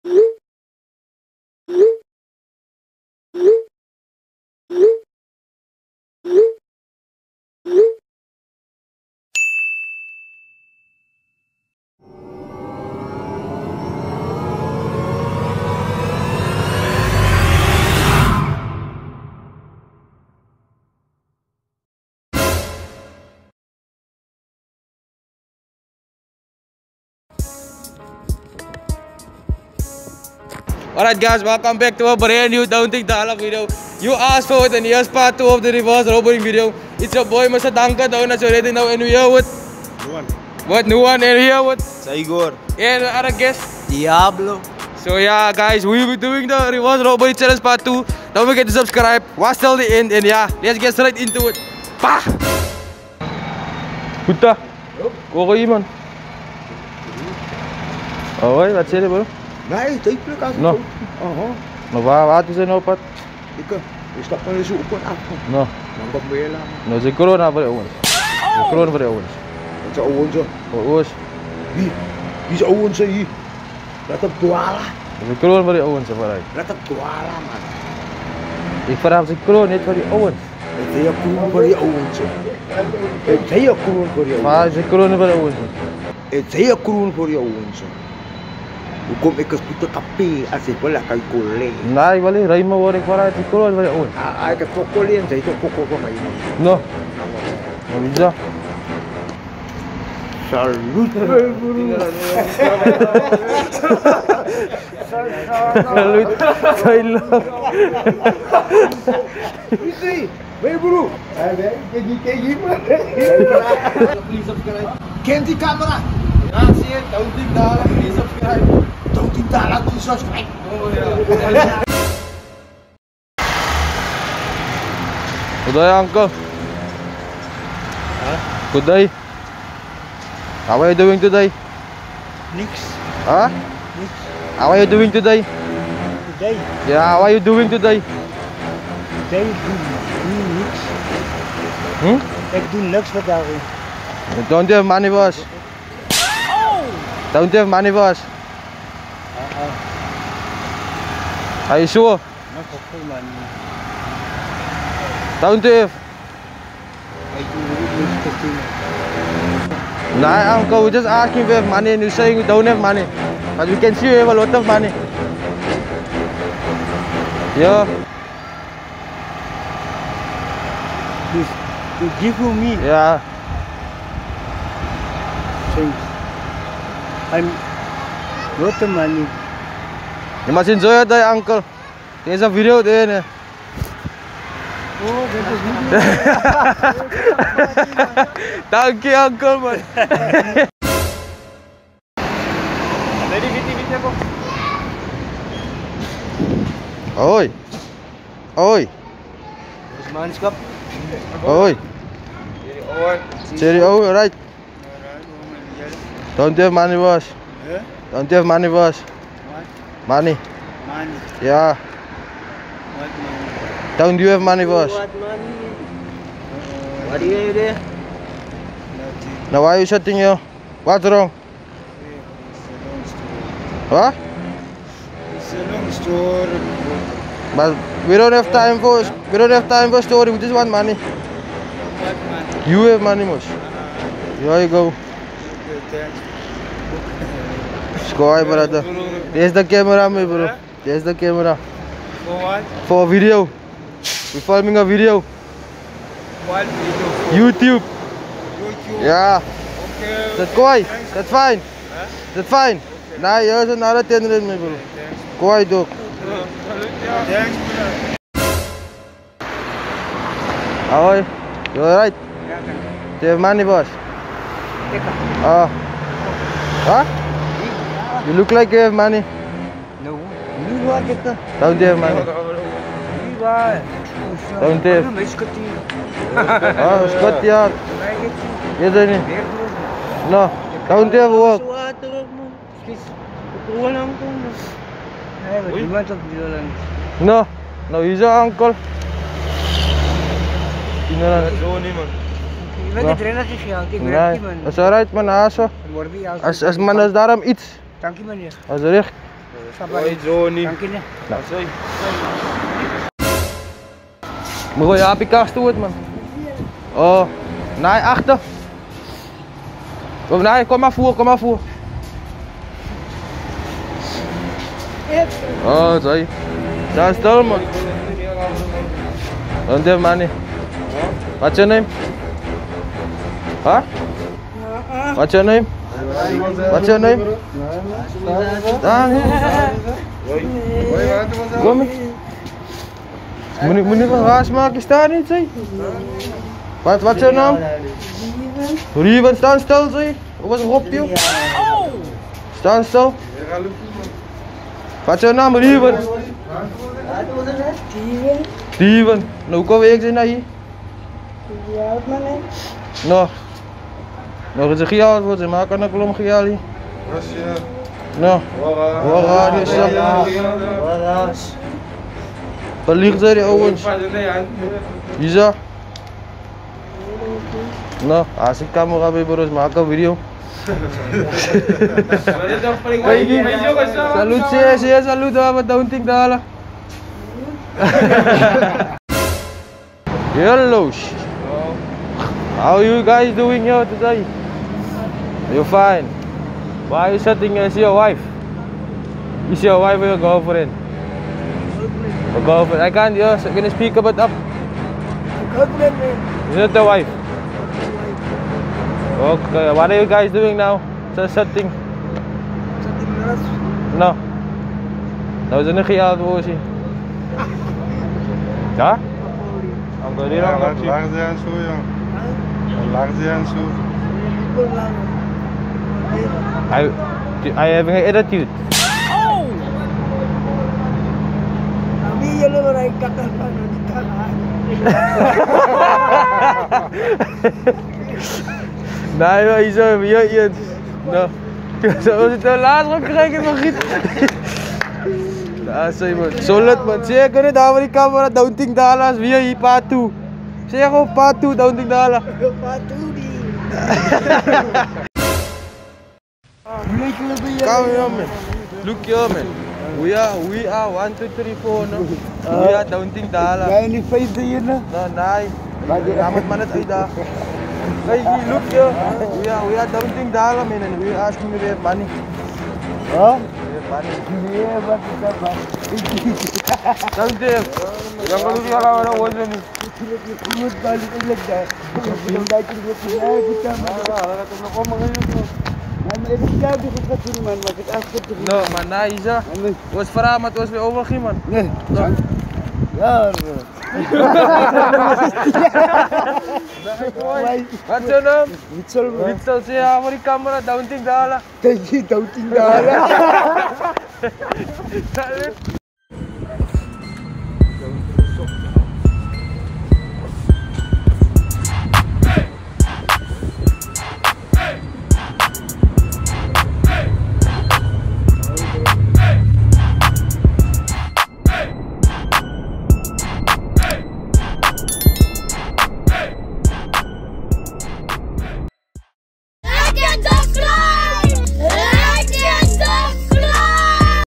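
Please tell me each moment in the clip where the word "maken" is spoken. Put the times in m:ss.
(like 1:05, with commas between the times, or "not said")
5:34, 5:55.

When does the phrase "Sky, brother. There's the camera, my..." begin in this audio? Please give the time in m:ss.
3:58.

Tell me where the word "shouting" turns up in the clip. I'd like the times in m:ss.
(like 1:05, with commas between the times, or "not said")
6:27.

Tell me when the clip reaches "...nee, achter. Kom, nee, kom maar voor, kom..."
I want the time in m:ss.
5:07.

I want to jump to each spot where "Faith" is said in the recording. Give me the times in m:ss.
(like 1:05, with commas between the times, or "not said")
7:34.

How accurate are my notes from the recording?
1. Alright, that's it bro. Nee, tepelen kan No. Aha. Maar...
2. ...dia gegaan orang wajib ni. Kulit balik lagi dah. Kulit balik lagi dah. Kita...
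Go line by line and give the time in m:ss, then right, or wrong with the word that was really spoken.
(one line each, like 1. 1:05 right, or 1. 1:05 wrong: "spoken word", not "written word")
1. 0:58 right
2. 7:48 wrong: "lawan", not "gegaan".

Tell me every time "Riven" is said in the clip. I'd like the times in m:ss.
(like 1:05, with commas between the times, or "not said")
5:38.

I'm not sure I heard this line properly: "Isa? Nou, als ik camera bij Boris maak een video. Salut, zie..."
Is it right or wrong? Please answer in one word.
right.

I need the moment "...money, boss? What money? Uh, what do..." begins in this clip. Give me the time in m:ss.
3:34.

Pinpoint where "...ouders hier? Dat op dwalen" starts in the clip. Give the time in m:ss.
1:12.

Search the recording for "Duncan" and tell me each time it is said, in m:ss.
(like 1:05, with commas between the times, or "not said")
0:37.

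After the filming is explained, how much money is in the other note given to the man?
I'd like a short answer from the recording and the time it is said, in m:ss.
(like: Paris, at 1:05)
10 rand, at 4:14.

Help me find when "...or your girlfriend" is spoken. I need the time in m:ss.
6:29.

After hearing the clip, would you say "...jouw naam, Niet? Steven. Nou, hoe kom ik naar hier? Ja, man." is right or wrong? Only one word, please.
wrong.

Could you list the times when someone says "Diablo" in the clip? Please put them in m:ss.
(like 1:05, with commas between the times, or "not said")
0:43.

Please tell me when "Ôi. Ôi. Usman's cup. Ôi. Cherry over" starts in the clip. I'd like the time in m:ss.
3:17.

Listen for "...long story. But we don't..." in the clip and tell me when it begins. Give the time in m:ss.
3:45.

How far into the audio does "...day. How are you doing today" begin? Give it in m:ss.
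2:08.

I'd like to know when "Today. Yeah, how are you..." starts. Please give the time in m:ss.
2:16.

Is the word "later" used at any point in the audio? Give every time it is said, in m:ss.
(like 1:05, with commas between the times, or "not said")
1:06, 7:12.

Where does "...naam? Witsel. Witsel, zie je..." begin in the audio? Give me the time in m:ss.
8:08.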